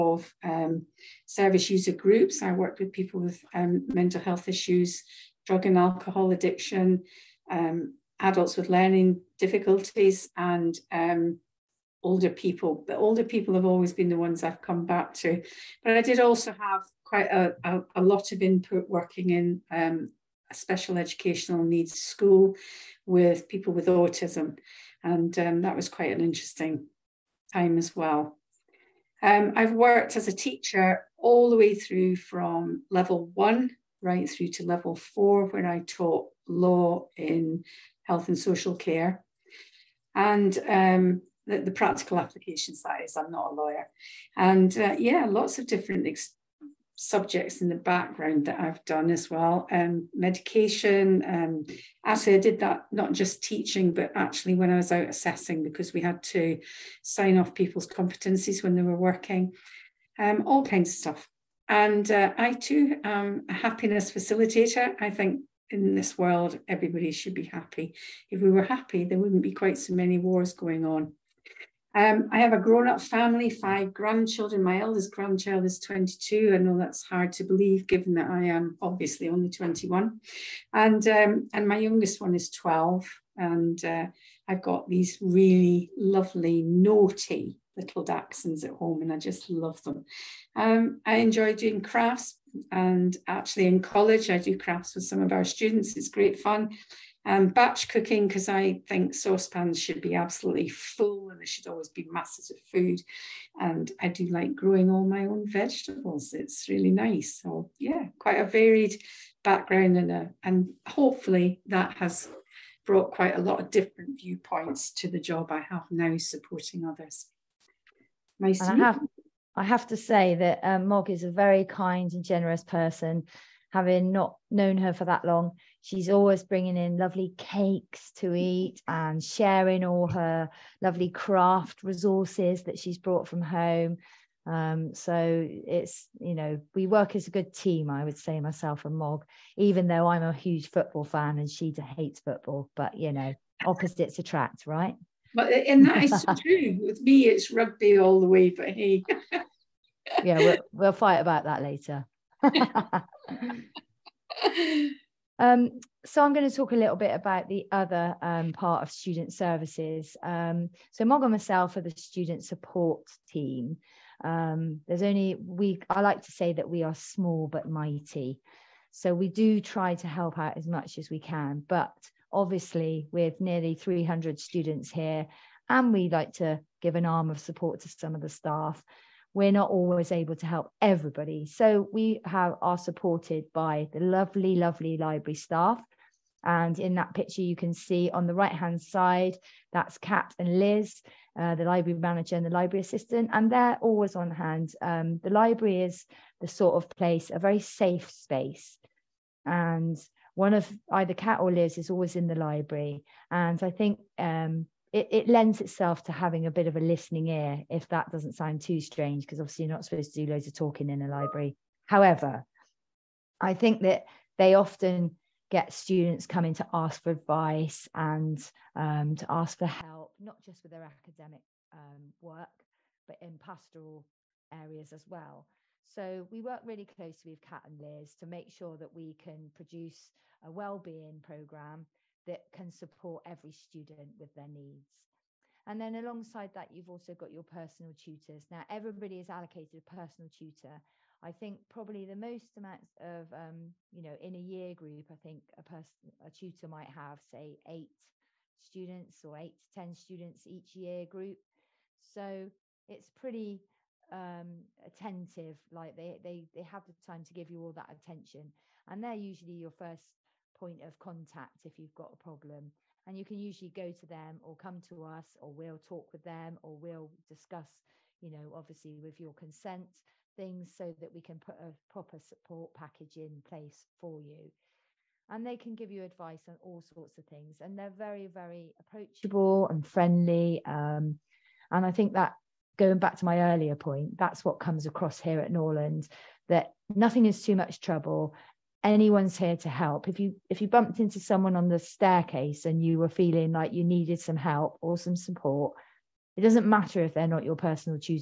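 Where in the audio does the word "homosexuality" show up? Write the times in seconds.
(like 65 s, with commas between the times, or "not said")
not said.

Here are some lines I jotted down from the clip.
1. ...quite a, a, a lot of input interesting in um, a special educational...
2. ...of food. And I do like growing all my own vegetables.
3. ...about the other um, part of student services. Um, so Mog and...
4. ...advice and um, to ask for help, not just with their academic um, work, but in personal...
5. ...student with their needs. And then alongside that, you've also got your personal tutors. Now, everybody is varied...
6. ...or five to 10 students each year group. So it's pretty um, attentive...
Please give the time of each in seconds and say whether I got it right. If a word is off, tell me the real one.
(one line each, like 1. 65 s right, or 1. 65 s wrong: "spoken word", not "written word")
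1. 17 s wrong: "working", not "interesting"
2. 102 s right
3. 157 s right
4. 217 s wrong: "pastoral", not "personal"
5. 233 s wrong: "allocated", not "varied"
6. 249 s wrong: "eight", not "five".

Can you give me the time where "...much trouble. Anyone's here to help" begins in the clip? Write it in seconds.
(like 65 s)
287 s.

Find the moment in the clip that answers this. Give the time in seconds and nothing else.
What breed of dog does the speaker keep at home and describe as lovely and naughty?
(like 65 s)
88 s.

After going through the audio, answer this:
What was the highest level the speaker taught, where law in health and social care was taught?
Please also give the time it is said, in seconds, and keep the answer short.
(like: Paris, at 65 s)
level 4, at 34 s.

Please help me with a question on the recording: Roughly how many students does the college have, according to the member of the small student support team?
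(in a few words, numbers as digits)
nearly 300.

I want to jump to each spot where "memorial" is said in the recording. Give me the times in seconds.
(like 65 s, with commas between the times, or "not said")
not said.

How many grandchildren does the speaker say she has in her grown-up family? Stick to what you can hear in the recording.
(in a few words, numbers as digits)
5.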